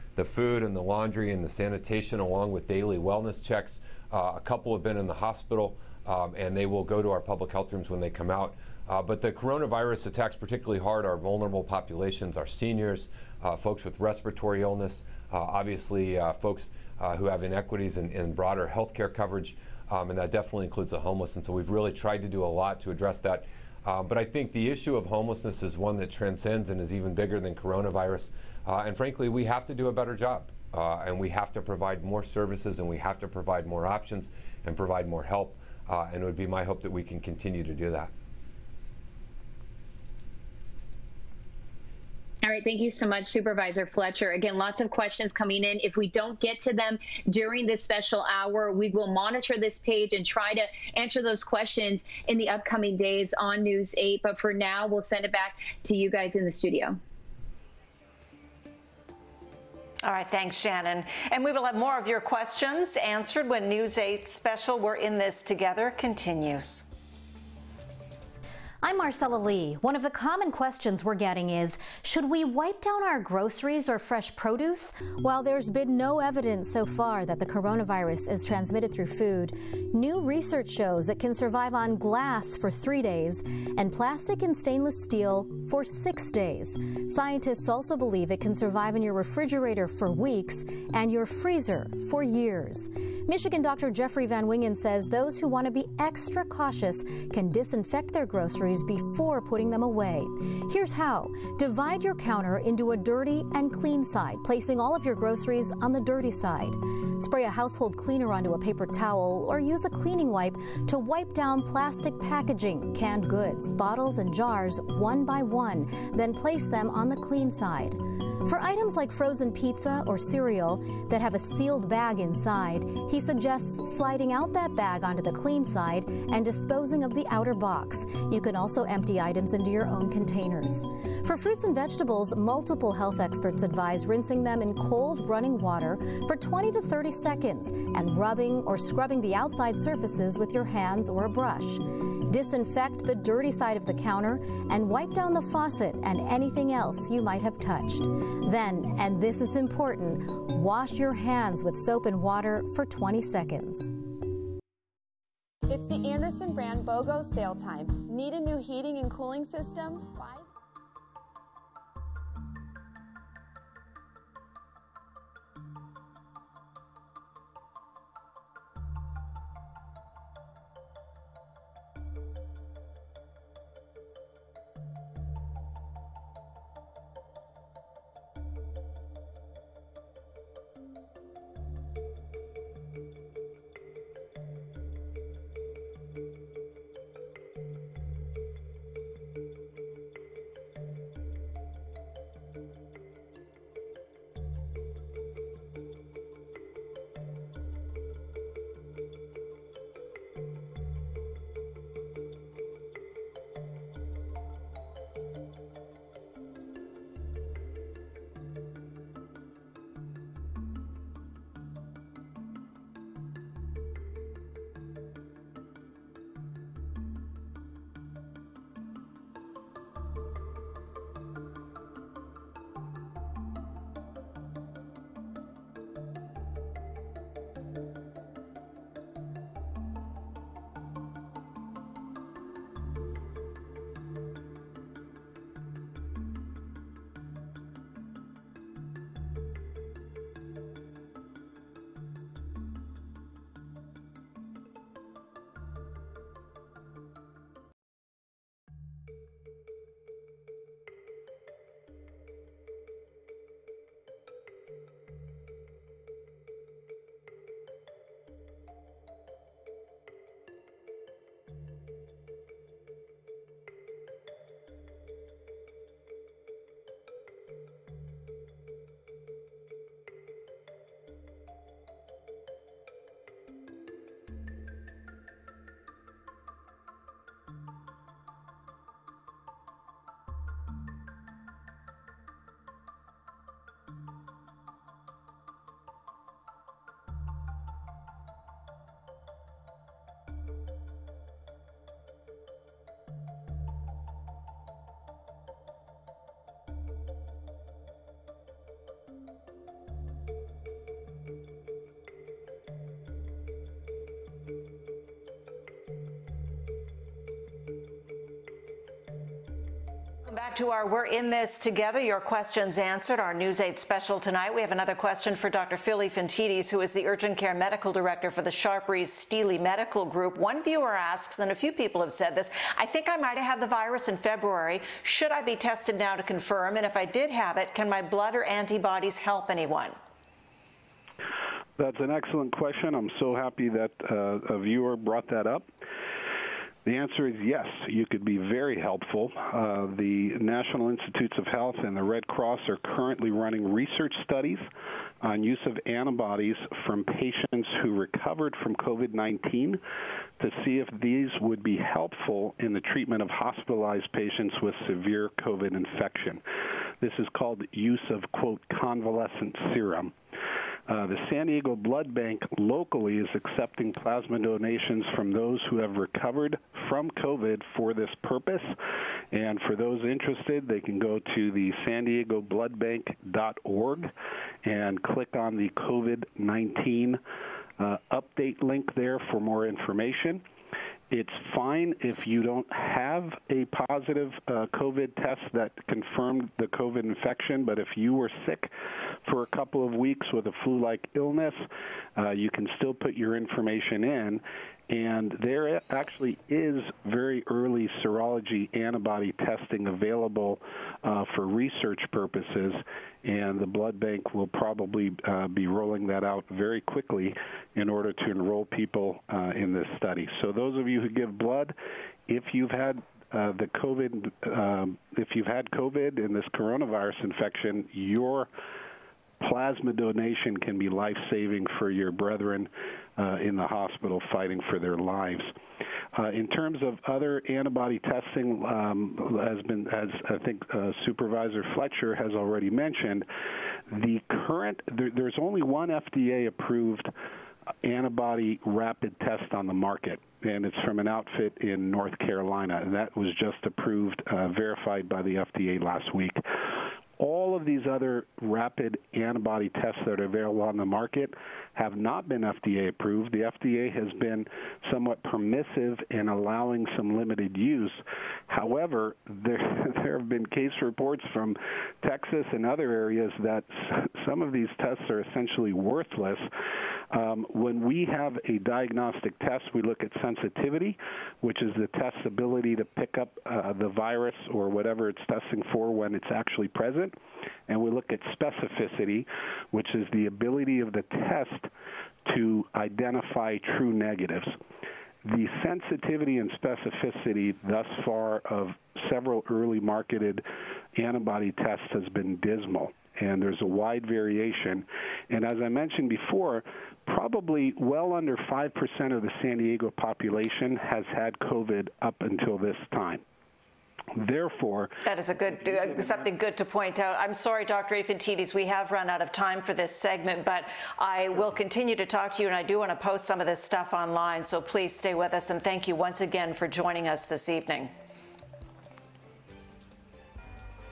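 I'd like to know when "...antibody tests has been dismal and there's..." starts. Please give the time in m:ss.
8:10.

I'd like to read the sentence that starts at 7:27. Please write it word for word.
All of these other rapid antibody tests that are available on the market have not been FDA approved.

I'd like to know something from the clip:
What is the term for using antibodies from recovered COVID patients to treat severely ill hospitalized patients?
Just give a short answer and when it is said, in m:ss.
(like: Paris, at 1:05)
convalescent serum, at 5:58.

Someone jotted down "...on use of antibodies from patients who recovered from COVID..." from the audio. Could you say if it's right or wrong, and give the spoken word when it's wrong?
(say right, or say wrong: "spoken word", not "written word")
right.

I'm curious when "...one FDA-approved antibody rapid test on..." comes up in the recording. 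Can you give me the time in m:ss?
7:15.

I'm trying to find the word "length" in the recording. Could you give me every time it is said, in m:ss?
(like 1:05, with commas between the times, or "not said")
not said.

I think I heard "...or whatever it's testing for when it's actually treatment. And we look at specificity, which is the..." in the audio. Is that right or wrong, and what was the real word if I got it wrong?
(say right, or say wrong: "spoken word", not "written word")
wrong: "present", not "treatment".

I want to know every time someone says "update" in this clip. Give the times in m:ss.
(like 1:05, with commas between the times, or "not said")
6:18.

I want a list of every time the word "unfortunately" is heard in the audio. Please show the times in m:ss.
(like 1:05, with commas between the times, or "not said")
not said.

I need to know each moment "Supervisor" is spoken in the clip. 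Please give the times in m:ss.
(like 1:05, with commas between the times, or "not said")
0:43, 7:11.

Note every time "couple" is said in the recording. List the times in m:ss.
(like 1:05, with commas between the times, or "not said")
0:04, 6:29.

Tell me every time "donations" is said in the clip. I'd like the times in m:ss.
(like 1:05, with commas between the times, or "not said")
6:04, 6:59.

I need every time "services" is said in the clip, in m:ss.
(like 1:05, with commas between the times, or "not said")
0:32.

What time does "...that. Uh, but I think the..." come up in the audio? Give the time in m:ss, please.
0:23.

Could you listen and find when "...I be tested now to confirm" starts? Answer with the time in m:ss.
5:25.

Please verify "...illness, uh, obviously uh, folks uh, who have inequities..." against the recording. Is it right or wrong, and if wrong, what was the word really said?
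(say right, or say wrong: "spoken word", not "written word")
right.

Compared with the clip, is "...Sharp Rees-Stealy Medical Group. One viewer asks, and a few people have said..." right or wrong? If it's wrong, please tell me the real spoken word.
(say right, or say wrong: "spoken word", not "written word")
right.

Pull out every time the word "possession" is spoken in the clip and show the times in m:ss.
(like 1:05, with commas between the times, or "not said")
not said.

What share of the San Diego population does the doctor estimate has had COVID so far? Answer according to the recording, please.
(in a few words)
under 5%.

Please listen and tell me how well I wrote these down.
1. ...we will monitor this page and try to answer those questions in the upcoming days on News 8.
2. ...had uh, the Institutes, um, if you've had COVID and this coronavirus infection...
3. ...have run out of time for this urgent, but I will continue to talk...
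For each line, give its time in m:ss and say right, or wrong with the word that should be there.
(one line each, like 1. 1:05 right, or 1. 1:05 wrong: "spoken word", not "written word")
1. 0:48 right
2. 6:52 wrong: "COVID", not "Institutes"
3. 8:28 wrong: "segment", not "urgent".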